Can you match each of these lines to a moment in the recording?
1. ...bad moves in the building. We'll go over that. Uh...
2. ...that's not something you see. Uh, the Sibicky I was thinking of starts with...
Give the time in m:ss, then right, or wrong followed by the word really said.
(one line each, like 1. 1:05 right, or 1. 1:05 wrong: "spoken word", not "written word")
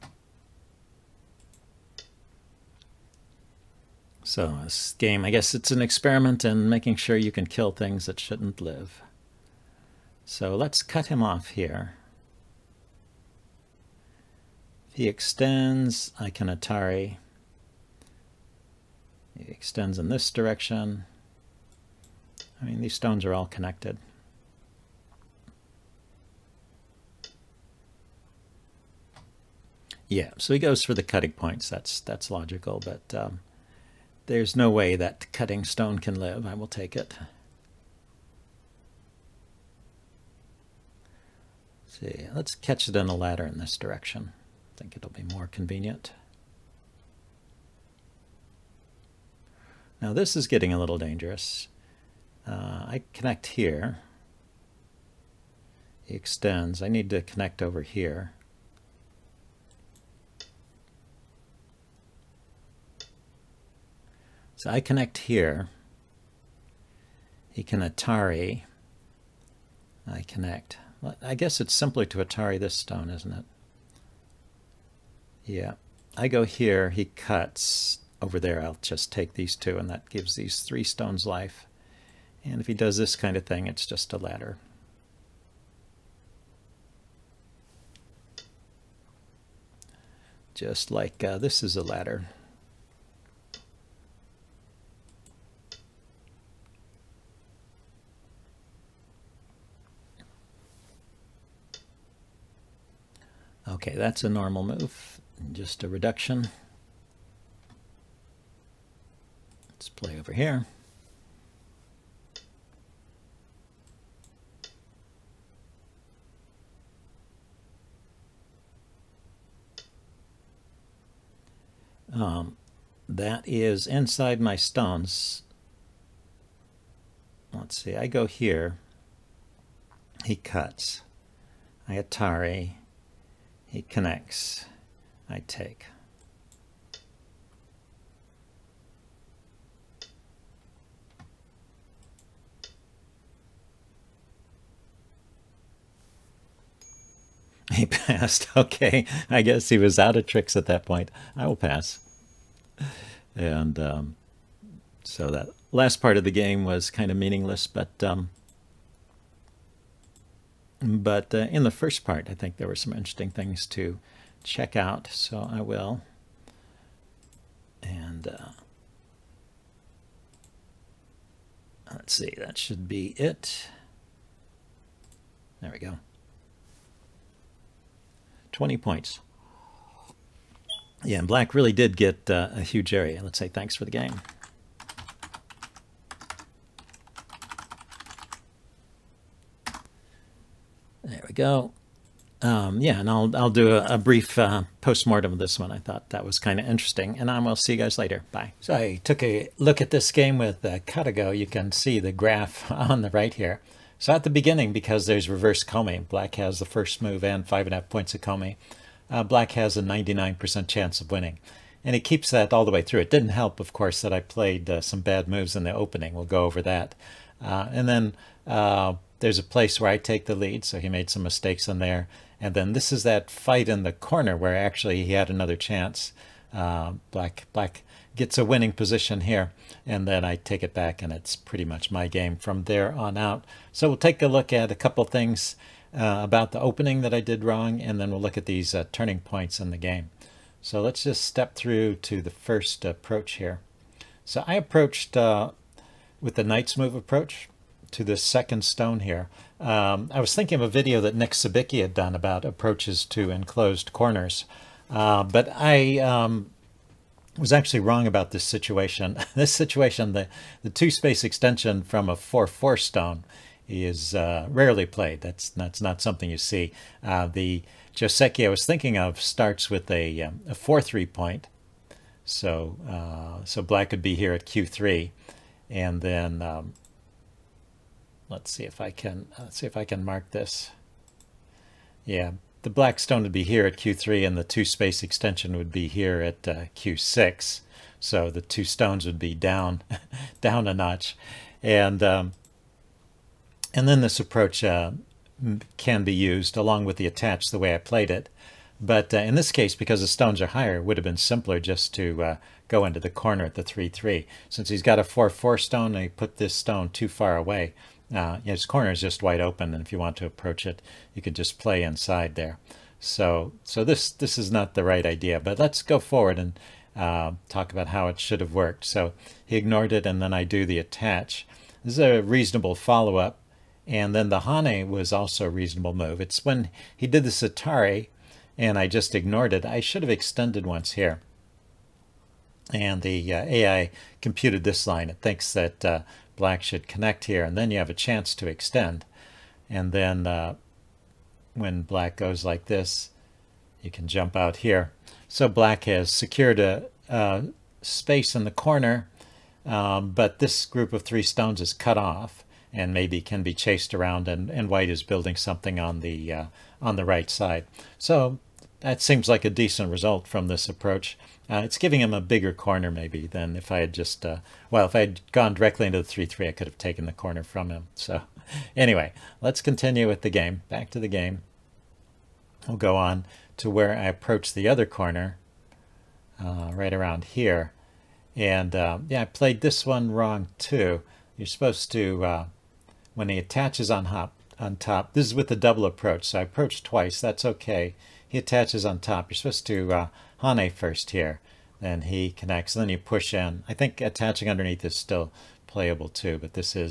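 1. 3:35 wrong: "opening", not "building"
2. 4:25 wrong: "Joseki", not "Sibicky".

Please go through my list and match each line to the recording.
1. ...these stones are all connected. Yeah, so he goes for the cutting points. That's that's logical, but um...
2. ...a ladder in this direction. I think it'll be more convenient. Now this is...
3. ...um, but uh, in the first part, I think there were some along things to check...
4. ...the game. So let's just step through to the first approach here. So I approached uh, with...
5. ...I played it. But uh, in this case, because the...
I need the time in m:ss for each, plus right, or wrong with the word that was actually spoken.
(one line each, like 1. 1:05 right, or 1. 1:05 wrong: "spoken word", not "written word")
1. 0:22 right
2. 0:43 right
3. 2:38 wrong: "interesting", not "along"
4. 3:59 right
5. 4:57 right.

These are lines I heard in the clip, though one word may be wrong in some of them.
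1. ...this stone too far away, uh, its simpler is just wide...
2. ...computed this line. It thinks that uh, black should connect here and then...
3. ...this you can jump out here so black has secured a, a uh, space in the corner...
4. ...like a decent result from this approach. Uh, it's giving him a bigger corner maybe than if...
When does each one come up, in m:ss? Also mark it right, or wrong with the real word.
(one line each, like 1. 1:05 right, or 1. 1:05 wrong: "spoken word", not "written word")
1. 5:06 wrong: "corner", not "simpler"
2. 5:34 right
3. 5:42 right
4. 5:59 right.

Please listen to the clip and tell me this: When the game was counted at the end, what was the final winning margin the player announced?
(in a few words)
20 points.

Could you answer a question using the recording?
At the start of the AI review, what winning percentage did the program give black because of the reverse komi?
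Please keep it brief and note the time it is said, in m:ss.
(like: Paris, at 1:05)
99%, at 3:29.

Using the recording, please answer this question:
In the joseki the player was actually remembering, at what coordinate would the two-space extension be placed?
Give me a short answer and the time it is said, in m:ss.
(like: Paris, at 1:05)
Q6, at 4:46.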